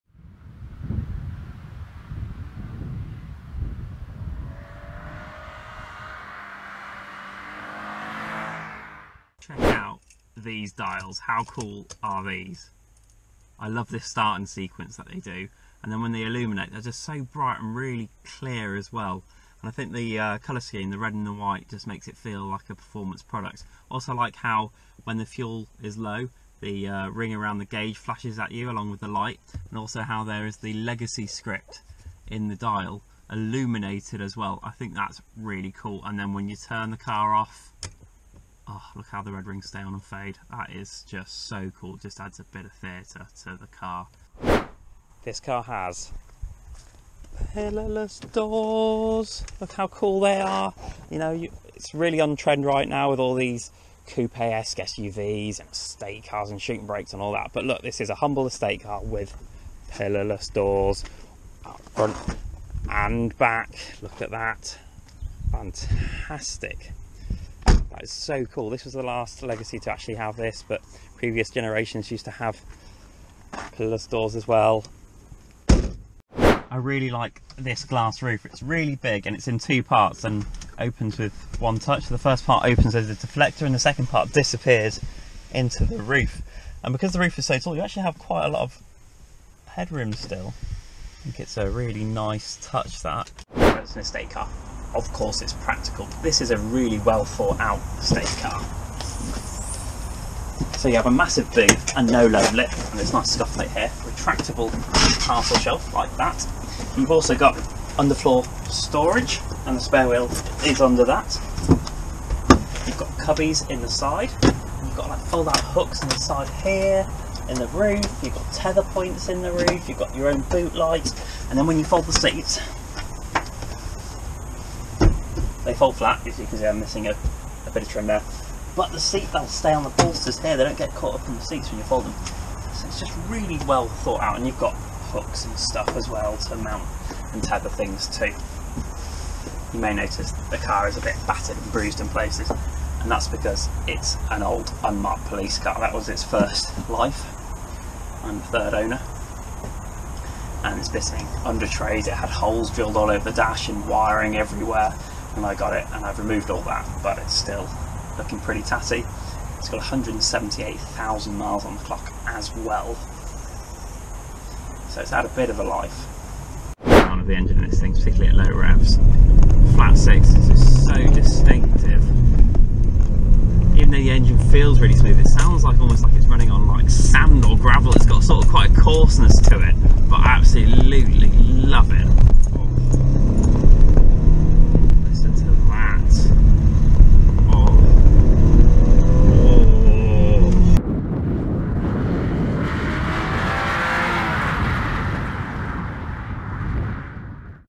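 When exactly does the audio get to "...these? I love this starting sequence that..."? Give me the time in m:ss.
0:12.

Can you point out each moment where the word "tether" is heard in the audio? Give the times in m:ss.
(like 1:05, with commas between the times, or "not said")
1:58, 2:17.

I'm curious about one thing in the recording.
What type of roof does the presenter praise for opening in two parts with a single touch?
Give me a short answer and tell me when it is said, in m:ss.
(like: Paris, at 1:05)
Glass roof, at 1:17.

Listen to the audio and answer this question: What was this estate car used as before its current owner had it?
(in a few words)
Unmarked police car.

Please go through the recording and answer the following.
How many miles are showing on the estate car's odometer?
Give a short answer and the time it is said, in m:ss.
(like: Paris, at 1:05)
178,000, at 2:39.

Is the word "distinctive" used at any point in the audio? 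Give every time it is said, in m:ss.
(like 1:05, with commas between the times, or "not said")
2:51.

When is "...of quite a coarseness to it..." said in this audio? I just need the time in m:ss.
2:58.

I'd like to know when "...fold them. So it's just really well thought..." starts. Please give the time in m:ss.
2:11.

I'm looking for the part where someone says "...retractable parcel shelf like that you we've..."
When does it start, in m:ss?
1:44.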